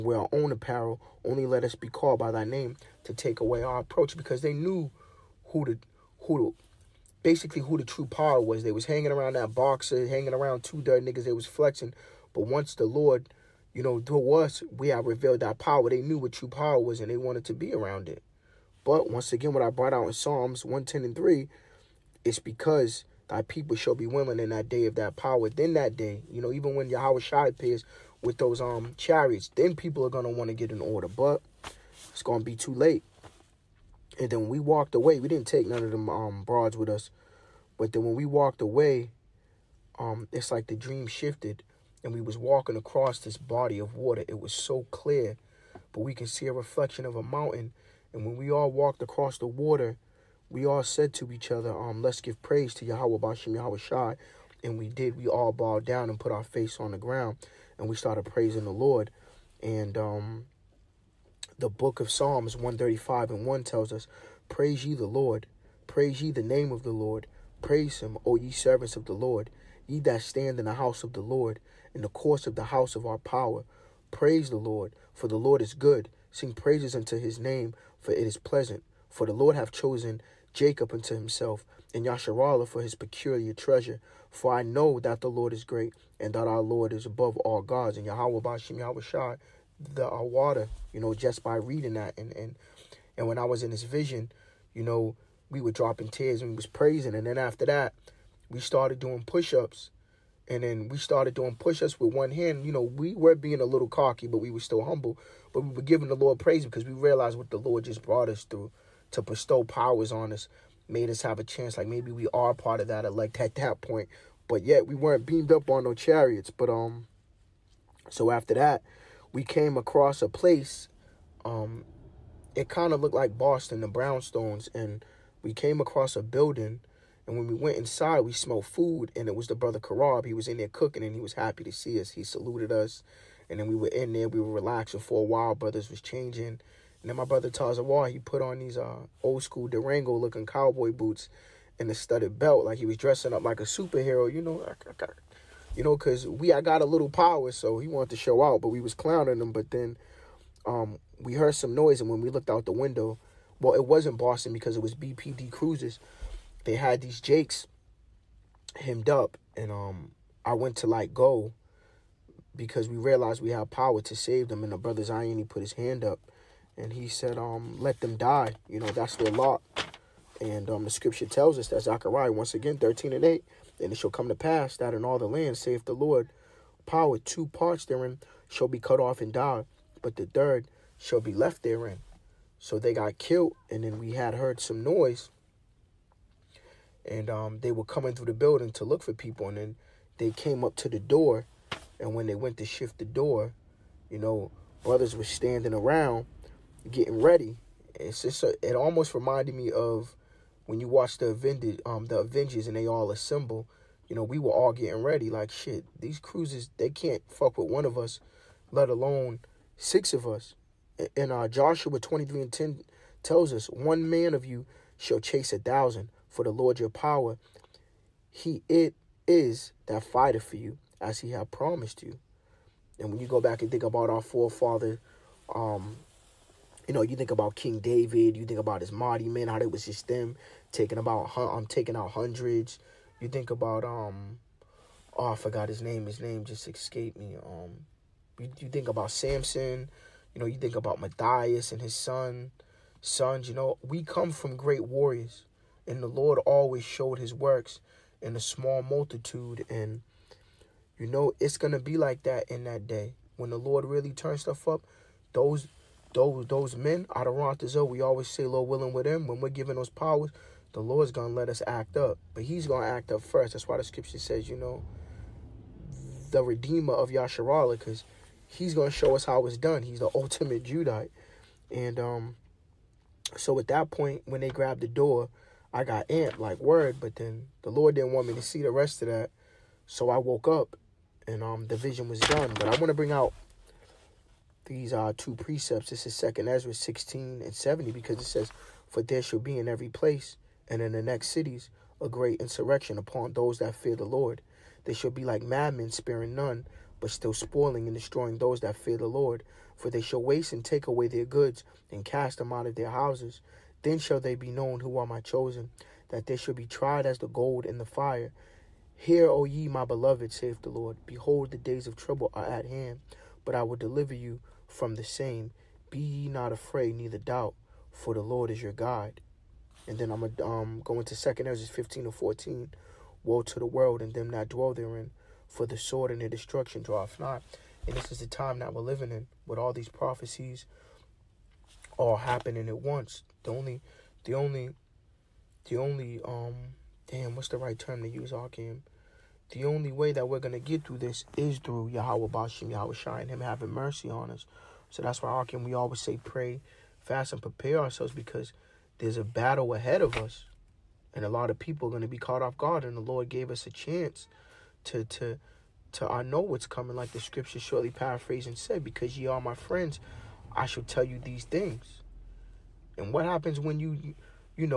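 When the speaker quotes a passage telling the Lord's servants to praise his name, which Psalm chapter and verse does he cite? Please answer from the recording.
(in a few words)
Psalms 135:1.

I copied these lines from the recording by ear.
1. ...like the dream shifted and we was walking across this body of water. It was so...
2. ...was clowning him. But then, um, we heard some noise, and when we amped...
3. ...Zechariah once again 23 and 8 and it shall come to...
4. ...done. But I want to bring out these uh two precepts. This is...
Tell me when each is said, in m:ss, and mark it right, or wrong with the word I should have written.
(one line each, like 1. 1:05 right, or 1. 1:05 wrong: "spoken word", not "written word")
1. 0:40 right
2. 2:28 wrong: "looked", not "amped"
3. 2:51 wrong: "13", not "23"
4. 4:42 right.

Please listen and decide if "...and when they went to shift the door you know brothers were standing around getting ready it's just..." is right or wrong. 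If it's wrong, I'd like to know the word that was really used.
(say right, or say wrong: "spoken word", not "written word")
right.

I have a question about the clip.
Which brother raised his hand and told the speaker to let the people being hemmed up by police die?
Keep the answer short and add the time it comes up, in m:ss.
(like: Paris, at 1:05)
Zion, at 2:45.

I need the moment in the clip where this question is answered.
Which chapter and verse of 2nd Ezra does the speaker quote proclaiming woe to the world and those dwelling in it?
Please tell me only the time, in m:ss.
5:21.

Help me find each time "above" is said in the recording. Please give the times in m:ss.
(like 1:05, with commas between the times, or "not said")
1:27.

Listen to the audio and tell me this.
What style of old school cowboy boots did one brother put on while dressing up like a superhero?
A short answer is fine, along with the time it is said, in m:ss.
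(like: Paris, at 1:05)
Durango, at 2:19.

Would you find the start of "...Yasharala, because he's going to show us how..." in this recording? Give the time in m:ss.
4:27.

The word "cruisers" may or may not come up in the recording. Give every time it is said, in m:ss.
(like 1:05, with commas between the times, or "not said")
2:35, 3:26.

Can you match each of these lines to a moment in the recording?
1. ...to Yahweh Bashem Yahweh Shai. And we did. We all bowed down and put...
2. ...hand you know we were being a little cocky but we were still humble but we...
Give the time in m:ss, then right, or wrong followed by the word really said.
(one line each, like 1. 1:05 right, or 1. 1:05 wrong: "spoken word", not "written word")
1. 0:52 right
2. 1:42 right.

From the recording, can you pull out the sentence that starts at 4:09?
And, you know, it's going to be like that in that day.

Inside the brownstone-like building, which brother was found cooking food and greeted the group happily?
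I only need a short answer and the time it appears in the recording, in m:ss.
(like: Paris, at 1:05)
Karab, at 2:09.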